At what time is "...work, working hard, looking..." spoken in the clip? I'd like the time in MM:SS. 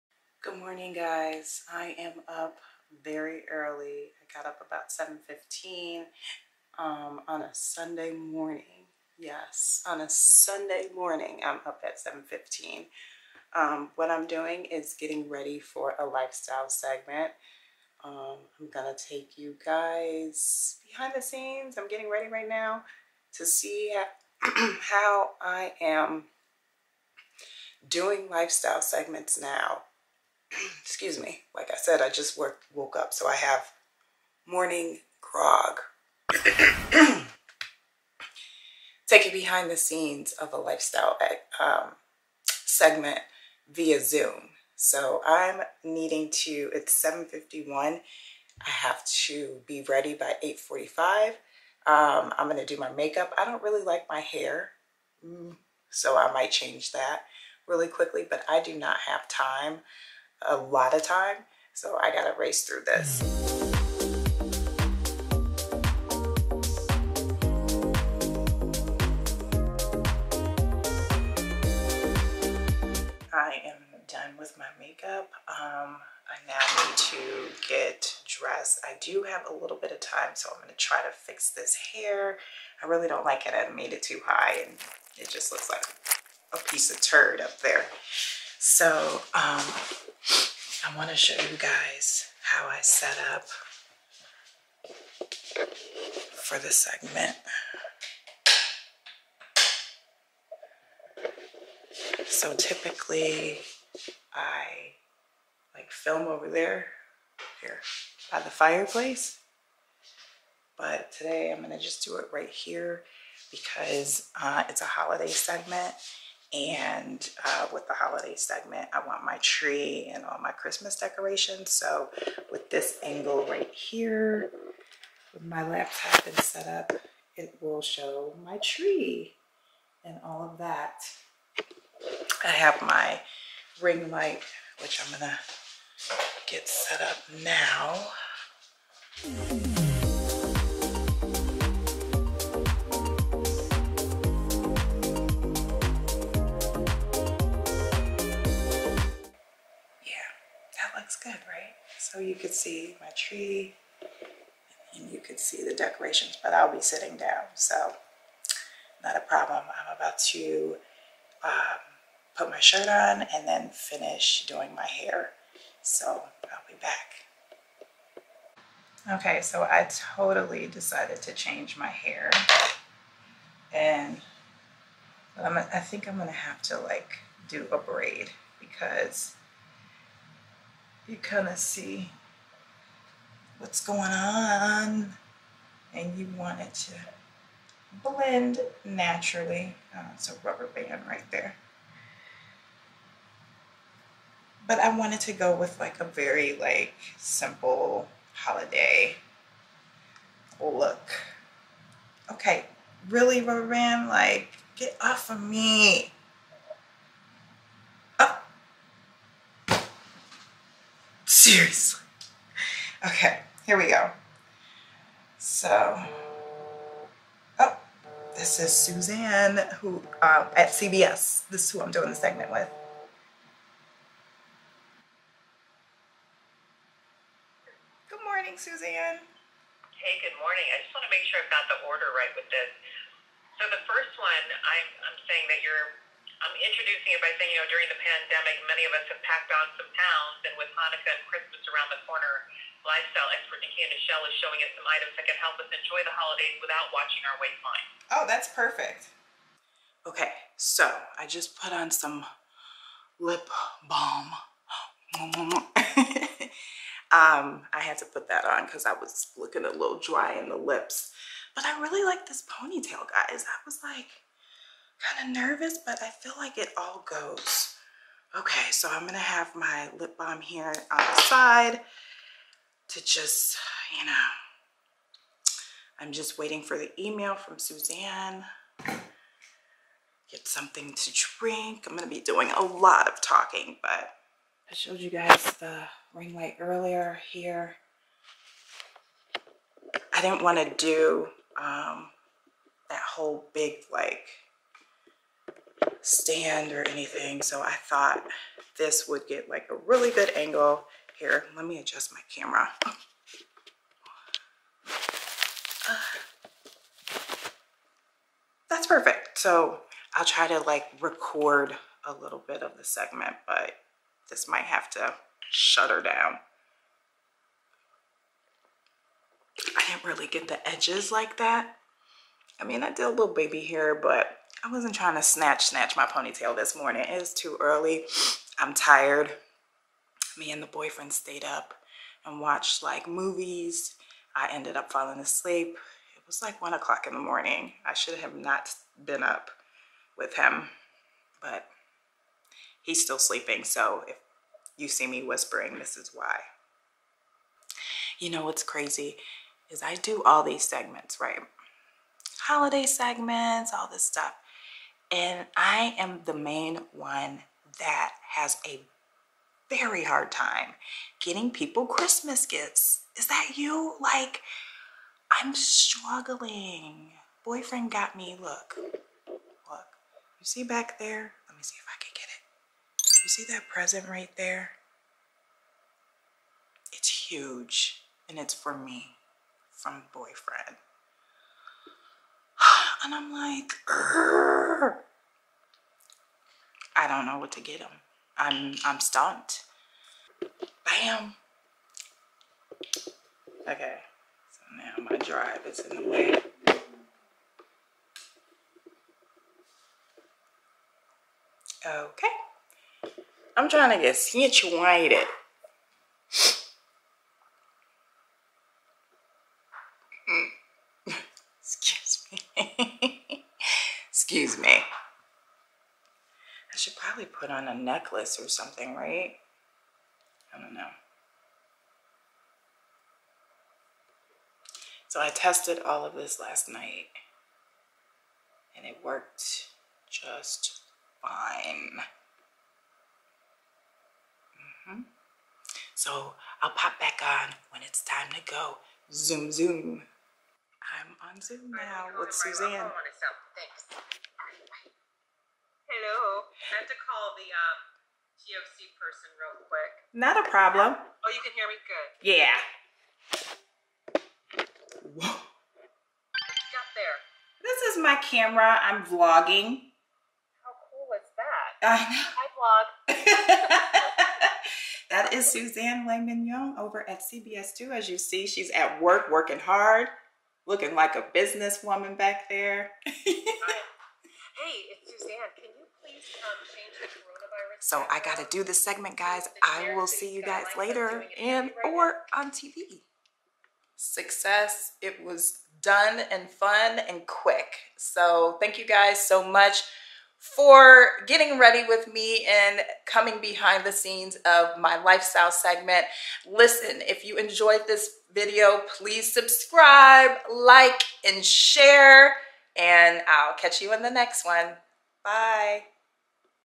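07:49.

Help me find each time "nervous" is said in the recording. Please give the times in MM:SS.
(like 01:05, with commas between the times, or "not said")
04:25.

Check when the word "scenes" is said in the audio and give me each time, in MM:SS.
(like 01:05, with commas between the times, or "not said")
00:21, 00:39, 08:13.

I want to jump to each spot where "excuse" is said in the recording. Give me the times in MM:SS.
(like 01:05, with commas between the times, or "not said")
00:30, 06:54.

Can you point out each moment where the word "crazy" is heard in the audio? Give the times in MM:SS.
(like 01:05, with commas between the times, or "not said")
05:48.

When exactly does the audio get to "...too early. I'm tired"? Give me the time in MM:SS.
05:27.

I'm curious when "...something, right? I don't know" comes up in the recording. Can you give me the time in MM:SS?
06:58.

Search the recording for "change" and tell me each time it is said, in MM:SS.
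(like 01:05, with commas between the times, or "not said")
00:56, 02:51, 07:56.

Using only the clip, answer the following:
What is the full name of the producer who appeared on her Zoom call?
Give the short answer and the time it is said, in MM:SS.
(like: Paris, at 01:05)
Suzanne Le Mignon, at 07:45.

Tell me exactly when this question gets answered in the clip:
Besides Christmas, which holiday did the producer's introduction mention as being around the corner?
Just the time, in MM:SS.
04:00.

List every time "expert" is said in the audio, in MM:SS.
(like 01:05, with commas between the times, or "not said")
04:03.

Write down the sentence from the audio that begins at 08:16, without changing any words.
Listen, if you enjoyed this video, please subscribe, like, and share and I'll catch you in the next one.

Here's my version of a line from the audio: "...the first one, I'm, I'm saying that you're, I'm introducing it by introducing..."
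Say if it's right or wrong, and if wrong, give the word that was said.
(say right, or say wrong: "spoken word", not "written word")
wrong: "saying", not "introducing".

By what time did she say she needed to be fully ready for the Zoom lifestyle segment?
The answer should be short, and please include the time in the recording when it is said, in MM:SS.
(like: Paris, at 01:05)
8:45, at 00:50.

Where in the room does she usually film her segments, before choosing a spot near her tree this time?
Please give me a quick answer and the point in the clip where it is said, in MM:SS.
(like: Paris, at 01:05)
by the fireplace, at 01:48.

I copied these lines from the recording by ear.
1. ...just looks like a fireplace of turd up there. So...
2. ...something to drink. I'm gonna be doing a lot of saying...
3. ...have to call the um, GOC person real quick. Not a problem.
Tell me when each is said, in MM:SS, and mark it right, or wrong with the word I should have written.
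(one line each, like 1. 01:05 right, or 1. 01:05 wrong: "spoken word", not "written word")
1. 01:25 wrong: "piece", not "fireplace"
2. 04:40 wrong: "talking", not "saying"
3. 07:26 right.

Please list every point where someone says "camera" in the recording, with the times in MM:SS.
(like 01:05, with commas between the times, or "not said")
05:02, 07:38.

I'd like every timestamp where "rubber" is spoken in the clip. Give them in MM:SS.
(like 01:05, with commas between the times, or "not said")
03:10, 03:23.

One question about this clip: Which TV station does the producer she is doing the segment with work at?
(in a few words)
CBS.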